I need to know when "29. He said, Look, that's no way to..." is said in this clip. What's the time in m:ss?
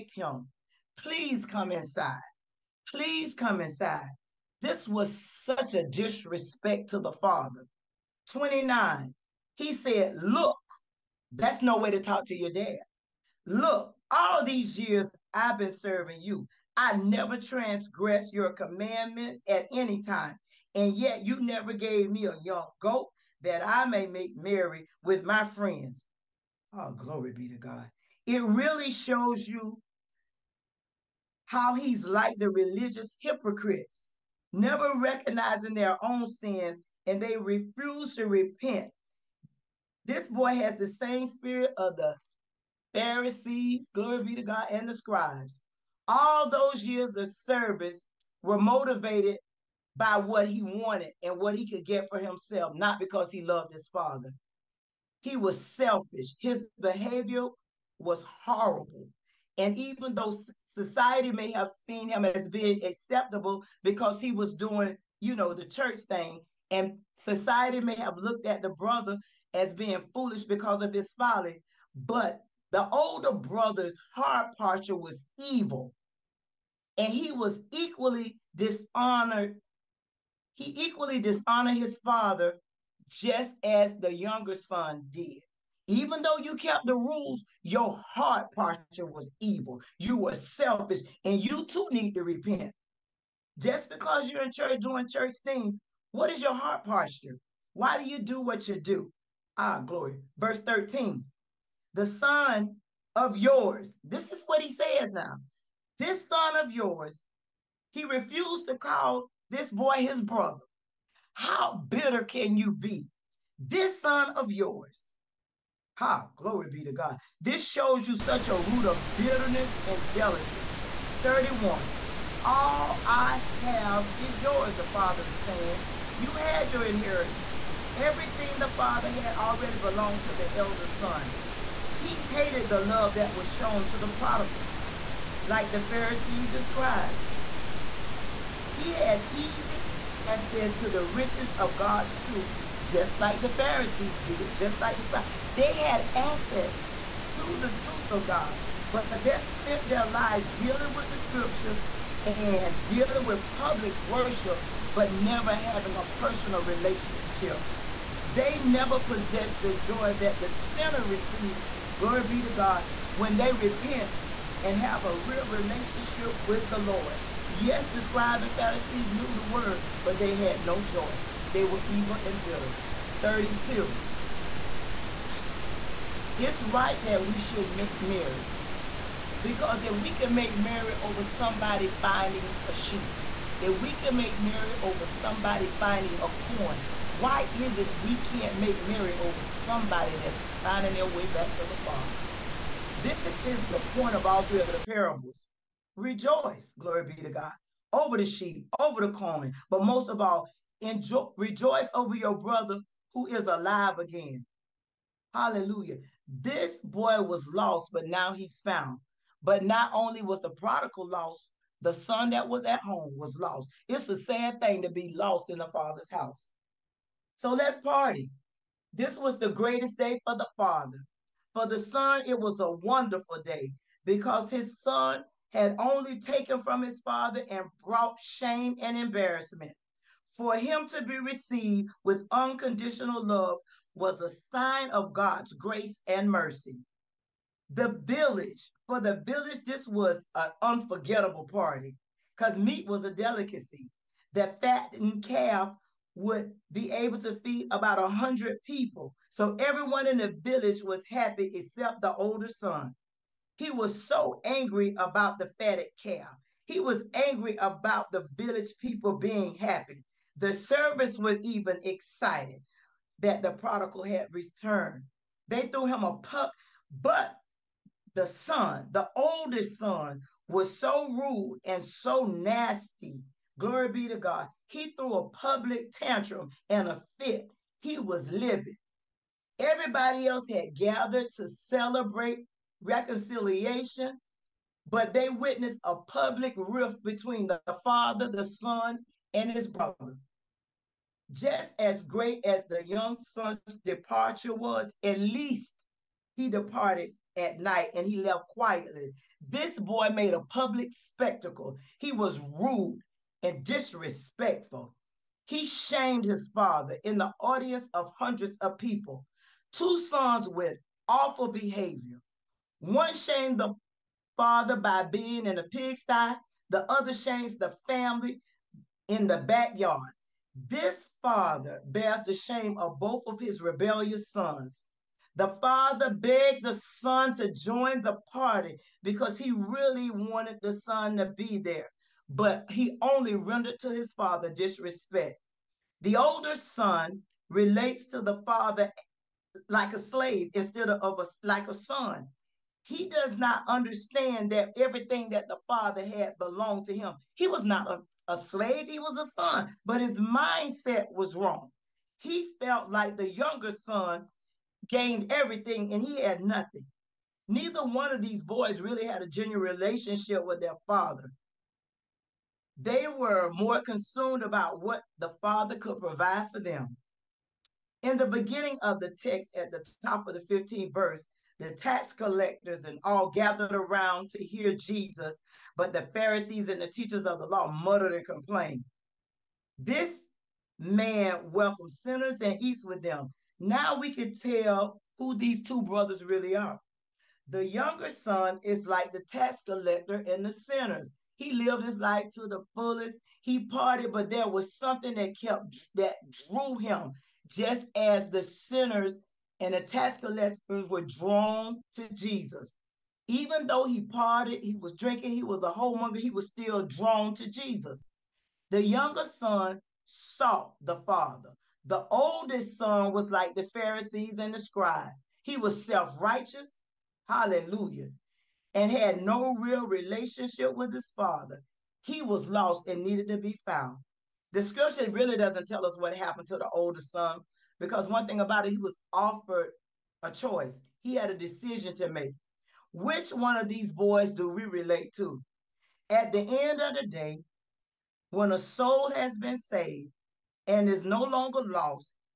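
0:08.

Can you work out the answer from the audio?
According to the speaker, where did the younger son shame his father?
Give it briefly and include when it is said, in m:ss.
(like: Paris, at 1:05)
pigsty, at 5:15.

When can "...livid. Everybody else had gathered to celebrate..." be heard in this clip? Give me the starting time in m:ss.
4:38.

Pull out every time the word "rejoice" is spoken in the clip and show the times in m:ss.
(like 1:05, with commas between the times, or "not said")
3:15, 3:21.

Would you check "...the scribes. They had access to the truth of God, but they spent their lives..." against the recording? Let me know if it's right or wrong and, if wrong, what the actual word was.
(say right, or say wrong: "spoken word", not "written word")
right.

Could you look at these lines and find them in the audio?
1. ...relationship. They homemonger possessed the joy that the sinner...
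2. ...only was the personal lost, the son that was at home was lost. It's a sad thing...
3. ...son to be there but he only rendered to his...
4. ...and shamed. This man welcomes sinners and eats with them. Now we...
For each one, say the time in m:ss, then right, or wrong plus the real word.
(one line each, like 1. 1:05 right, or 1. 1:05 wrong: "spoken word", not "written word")
1. 2:36 wrong: "never", not "homemonger"
2. 3:29 wrong: "prodigal", not "personal"
3. 5:30 right
4. 6:18 wrong: "complained", not "shamed".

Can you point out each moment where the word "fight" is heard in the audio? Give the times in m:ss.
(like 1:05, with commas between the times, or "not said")
not said.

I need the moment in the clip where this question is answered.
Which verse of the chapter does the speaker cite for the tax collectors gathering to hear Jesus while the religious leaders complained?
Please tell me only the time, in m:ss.
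6:10.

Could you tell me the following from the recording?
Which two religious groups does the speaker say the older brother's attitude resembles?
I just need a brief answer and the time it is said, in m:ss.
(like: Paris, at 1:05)
Pharisees and scribes, at 0:42.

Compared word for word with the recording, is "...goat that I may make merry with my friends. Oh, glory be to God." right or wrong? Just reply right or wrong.
right.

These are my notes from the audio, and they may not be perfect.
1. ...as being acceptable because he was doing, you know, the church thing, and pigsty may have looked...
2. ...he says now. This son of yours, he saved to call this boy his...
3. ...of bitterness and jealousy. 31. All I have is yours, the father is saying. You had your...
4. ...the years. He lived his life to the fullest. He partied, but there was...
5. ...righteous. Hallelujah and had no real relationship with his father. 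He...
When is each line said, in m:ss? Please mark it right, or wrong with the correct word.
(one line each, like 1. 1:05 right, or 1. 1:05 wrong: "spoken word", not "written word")
1. 1:02 wrong: "society", not "pigsty"
2. 1:44 wrong: "refused", not "saved"
3. 1:58 right
4. 6:30 wrong: "sinners", not "years"
5. 6:56 right.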